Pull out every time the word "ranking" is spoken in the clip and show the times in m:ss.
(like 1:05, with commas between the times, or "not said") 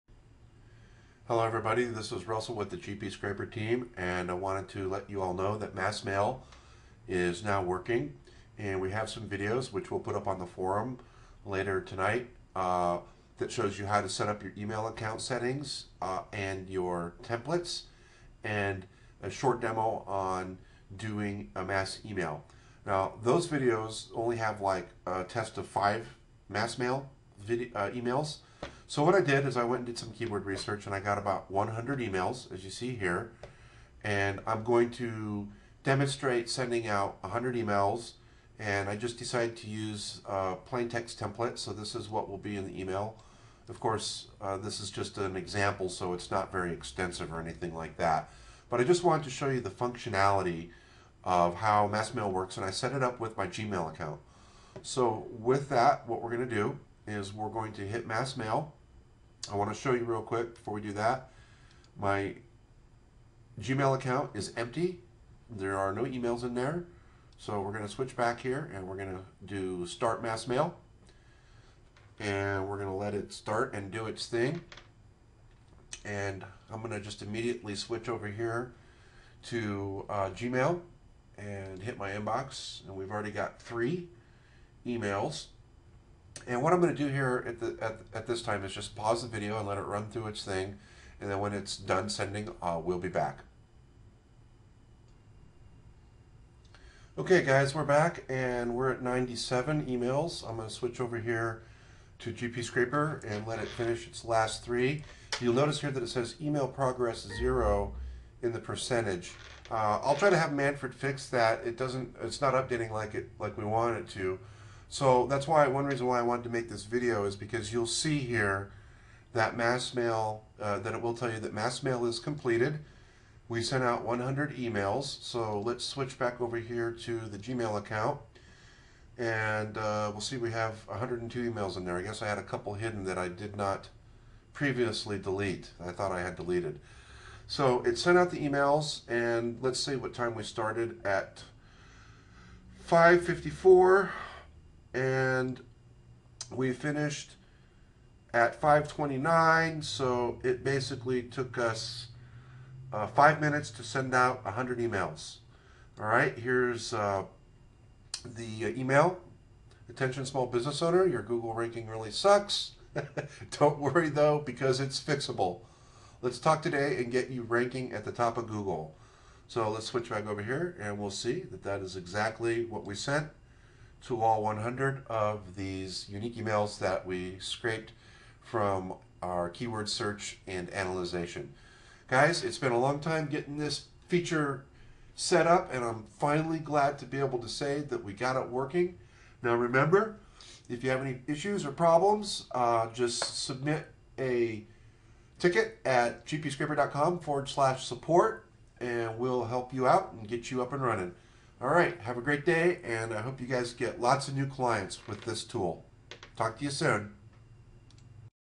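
2:41, 2:47.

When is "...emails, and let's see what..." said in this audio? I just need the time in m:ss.
2:18.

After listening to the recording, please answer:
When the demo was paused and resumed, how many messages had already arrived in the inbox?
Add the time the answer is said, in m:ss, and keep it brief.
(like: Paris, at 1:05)
97, at 1:39.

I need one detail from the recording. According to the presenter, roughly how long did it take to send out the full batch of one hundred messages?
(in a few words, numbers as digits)
5 minutes.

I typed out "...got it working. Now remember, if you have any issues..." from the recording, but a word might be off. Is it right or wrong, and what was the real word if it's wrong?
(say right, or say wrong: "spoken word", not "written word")
right.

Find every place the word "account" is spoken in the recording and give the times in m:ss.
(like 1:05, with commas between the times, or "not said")
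0:14, 0:53, 1:03, 2:07.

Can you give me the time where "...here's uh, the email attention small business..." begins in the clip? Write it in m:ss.
2:36.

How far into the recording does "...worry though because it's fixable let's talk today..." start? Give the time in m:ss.
2:43.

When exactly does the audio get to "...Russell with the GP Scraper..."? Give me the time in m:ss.
0:02.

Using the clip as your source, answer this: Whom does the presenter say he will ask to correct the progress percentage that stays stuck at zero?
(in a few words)
Manfred.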